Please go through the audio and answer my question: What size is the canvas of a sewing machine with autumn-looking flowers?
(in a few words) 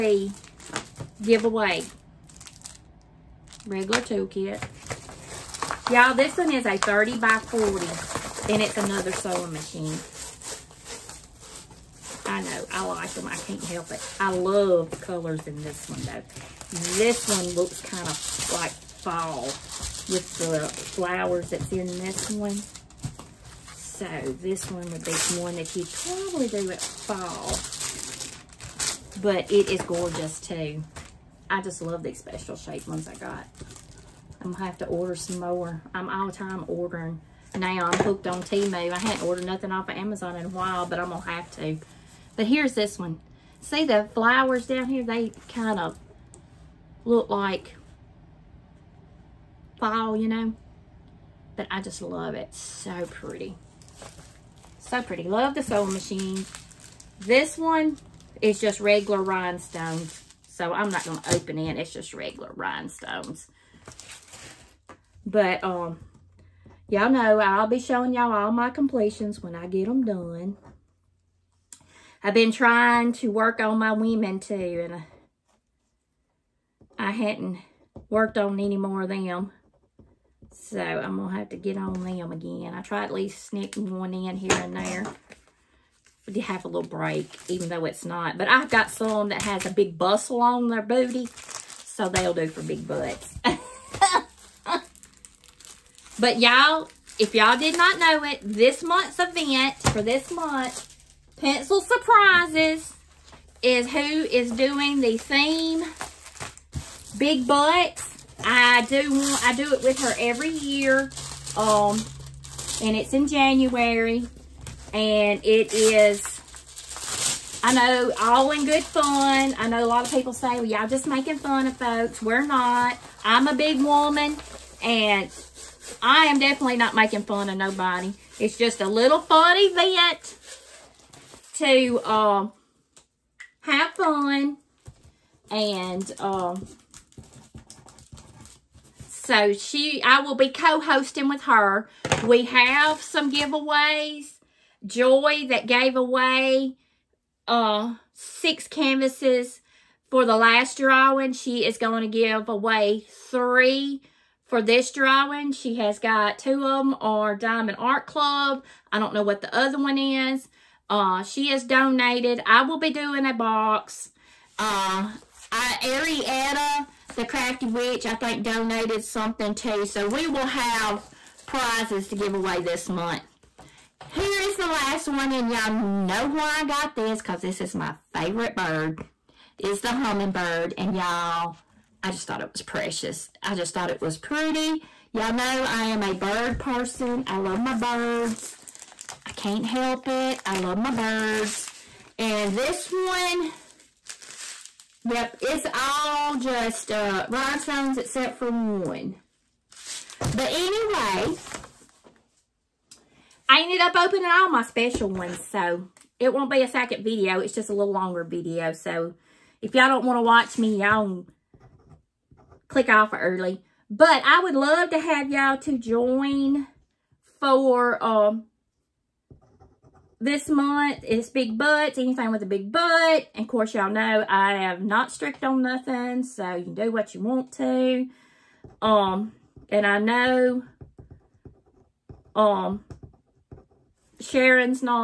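30 by 40.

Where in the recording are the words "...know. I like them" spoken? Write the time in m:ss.
0:12.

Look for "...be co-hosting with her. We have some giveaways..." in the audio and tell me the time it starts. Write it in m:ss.
2:20.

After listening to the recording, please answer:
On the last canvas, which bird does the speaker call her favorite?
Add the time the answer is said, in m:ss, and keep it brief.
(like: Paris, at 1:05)
Hummingbird, at 2:59.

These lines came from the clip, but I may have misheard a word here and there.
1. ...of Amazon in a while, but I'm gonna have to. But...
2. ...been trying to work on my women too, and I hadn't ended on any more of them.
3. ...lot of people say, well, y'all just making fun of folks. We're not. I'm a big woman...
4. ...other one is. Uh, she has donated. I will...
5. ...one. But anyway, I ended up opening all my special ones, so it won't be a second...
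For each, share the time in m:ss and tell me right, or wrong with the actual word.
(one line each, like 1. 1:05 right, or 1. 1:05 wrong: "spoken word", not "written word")
1. 0:39 right
2. 1:12 wrong: "worked", not "ended"
3. 1:59 right
4. 2:39 right
5. 3:18 right.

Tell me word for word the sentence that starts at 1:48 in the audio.
I do want, I do it with her every year.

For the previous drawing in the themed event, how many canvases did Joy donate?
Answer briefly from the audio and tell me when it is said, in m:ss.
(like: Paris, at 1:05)
6, at 2:28.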